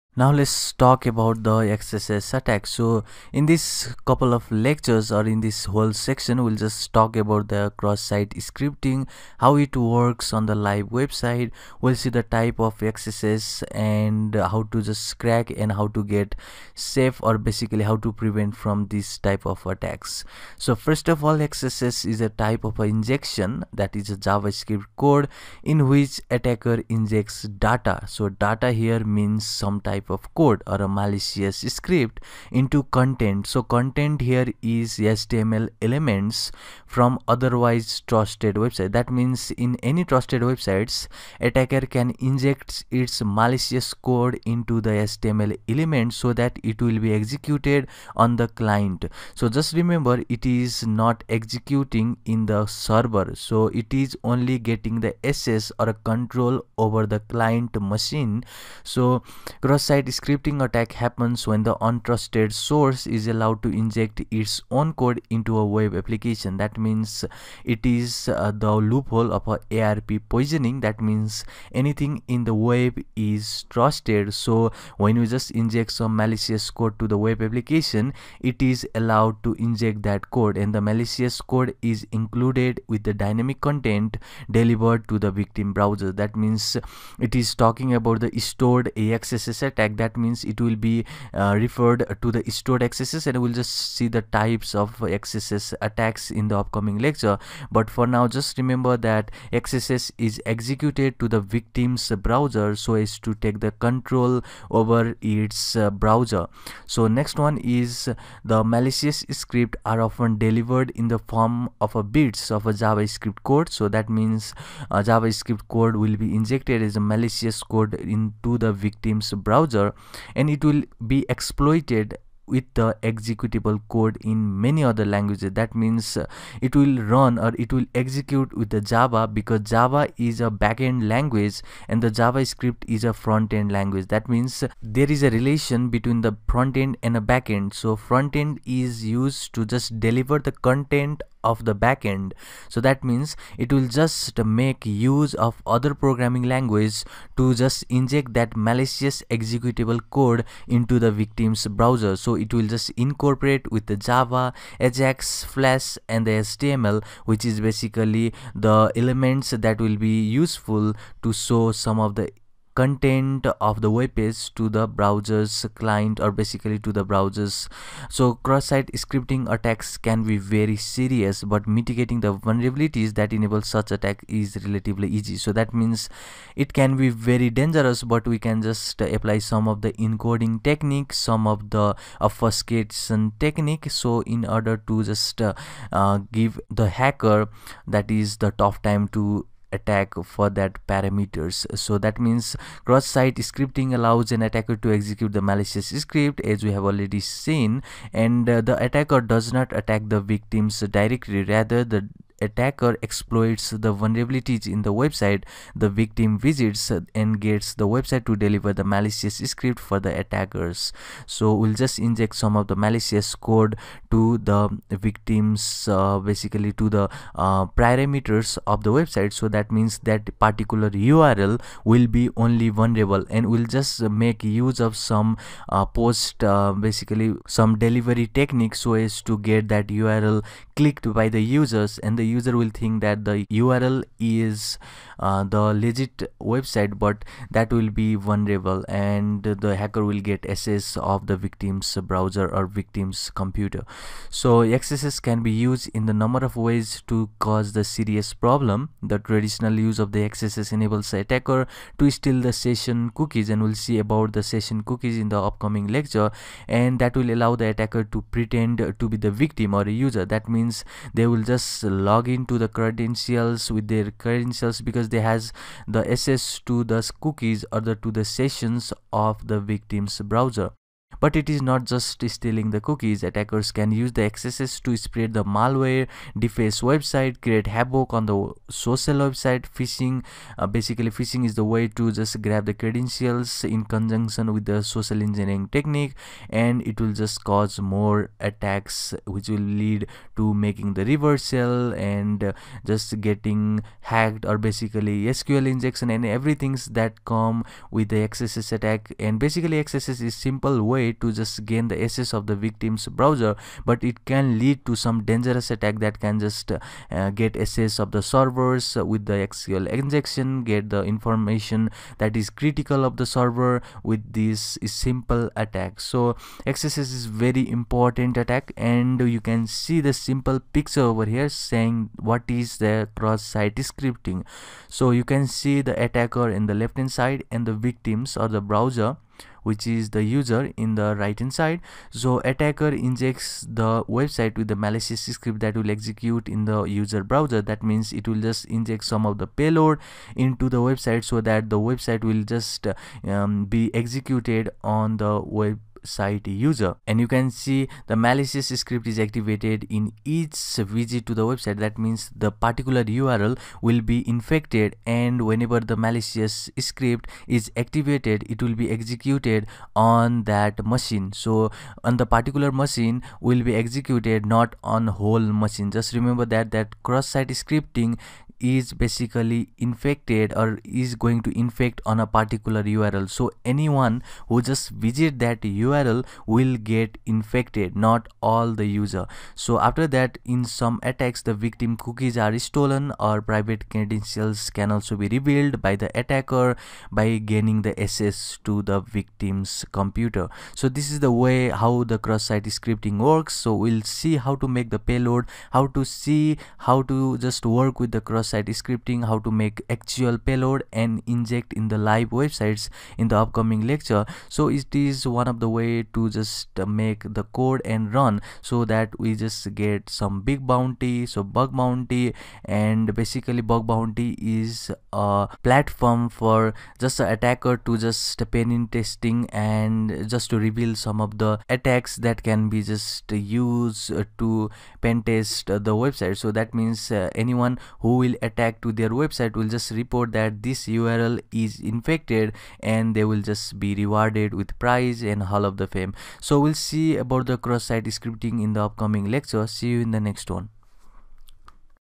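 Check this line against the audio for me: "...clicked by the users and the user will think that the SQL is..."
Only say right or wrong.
wrong.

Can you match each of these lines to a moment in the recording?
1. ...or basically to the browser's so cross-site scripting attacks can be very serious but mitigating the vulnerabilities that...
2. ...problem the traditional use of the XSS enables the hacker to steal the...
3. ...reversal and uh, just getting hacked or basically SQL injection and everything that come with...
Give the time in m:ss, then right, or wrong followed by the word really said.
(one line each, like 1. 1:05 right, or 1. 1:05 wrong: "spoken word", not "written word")
1. 2:46 right
2. 4:08 wrong: "attacker", not "hacker"
3. 4:51 right.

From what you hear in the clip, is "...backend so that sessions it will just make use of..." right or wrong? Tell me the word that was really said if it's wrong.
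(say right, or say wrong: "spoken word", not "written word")
wrong: "means", not "sessions".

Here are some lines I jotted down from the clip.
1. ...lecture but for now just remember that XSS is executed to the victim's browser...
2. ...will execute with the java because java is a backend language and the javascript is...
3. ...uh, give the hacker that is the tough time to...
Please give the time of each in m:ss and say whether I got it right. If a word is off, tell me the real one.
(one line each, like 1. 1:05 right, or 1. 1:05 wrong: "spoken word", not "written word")
1. 1:37 right
2. 2:07 right
3. 3:06 right.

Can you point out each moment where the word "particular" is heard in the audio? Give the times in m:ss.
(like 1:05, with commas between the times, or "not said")
3:40, 5:52, 6:02, 6:12.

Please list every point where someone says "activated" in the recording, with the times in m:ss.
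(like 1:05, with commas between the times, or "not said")
5:49, 5:57.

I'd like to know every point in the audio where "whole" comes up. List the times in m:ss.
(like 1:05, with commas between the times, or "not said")
0:05, 6:05.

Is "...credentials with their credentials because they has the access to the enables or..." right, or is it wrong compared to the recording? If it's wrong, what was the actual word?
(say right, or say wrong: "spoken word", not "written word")
wrong: "cookies", not "enables".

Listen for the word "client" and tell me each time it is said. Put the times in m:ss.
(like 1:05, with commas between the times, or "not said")
0:48, 0:57, 2:45.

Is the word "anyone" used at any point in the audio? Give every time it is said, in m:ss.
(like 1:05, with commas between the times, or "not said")
6:13, 7:07.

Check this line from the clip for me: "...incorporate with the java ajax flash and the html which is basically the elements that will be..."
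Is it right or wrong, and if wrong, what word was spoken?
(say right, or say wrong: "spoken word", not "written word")
right.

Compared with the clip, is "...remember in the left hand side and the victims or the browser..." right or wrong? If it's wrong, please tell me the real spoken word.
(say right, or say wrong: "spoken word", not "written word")
wrong: "attacker", not "remember".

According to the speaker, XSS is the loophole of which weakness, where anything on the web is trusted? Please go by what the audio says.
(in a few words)
ARP poisoning.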